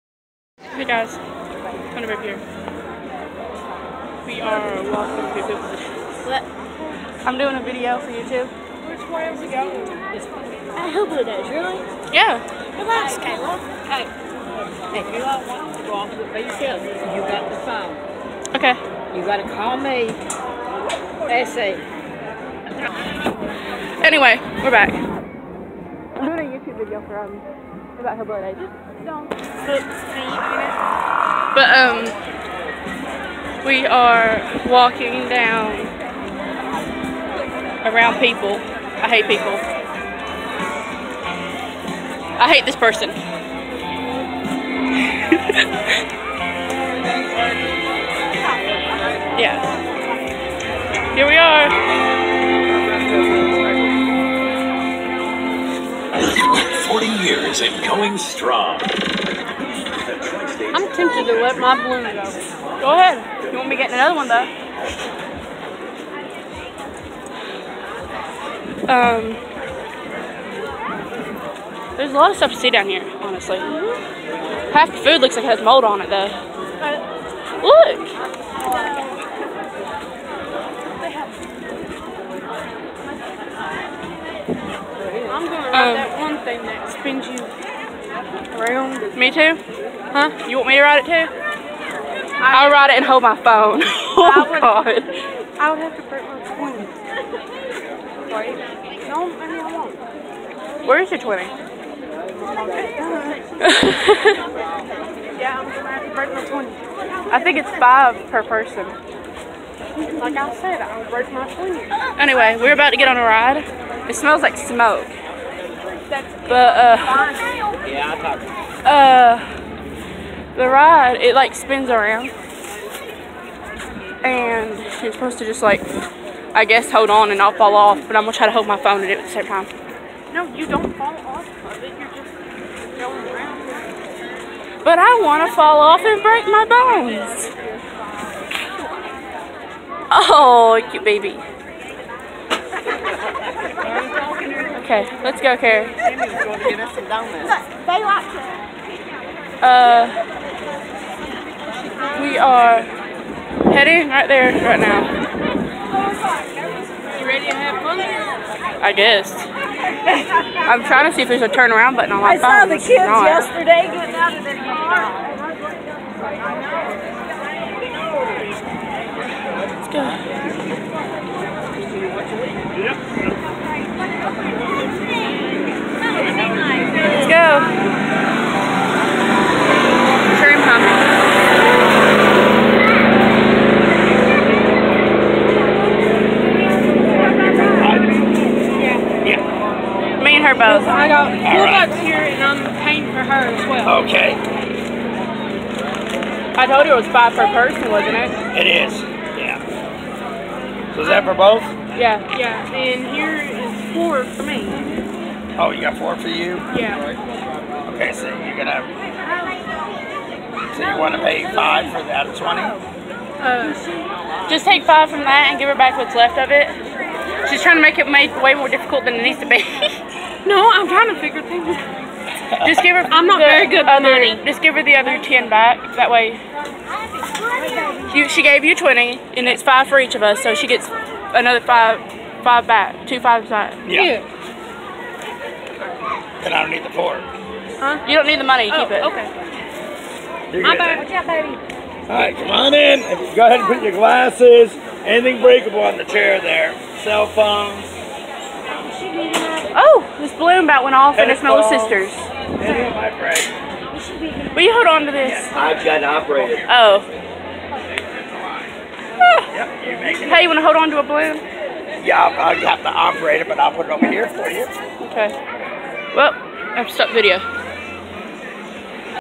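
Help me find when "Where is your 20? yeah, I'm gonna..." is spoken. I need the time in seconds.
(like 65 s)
100 s.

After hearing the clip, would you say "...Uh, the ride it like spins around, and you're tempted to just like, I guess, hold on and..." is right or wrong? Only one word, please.
wrong.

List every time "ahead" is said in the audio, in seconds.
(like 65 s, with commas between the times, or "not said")
62 s, 243 s.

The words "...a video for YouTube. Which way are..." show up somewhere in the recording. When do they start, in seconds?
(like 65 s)
7 s.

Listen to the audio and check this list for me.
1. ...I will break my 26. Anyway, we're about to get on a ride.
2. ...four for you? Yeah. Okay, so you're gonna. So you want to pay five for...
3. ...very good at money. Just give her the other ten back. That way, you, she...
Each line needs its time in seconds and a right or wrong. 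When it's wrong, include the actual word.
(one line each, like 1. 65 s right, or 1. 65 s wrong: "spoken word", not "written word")
1. 110 s wrong: "20", not "26"
2. 205 s right
3. 223 s right.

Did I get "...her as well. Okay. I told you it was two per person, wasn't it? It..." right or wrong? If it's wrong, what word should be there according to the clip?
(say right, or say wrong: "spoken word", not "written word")
wrong: "five", not "two".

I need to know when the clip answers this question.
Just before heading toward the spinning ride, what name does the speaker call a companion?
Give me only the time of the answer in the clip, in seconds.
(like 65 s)
145 s.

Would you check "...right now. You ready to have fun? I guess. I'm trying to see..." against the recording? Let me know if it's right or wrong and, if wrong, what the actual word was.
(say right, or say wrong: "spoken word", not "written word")
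right.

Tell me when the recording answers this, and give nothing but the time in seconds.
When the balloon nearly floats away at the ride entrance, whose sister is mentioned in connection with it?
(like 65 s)
251 s.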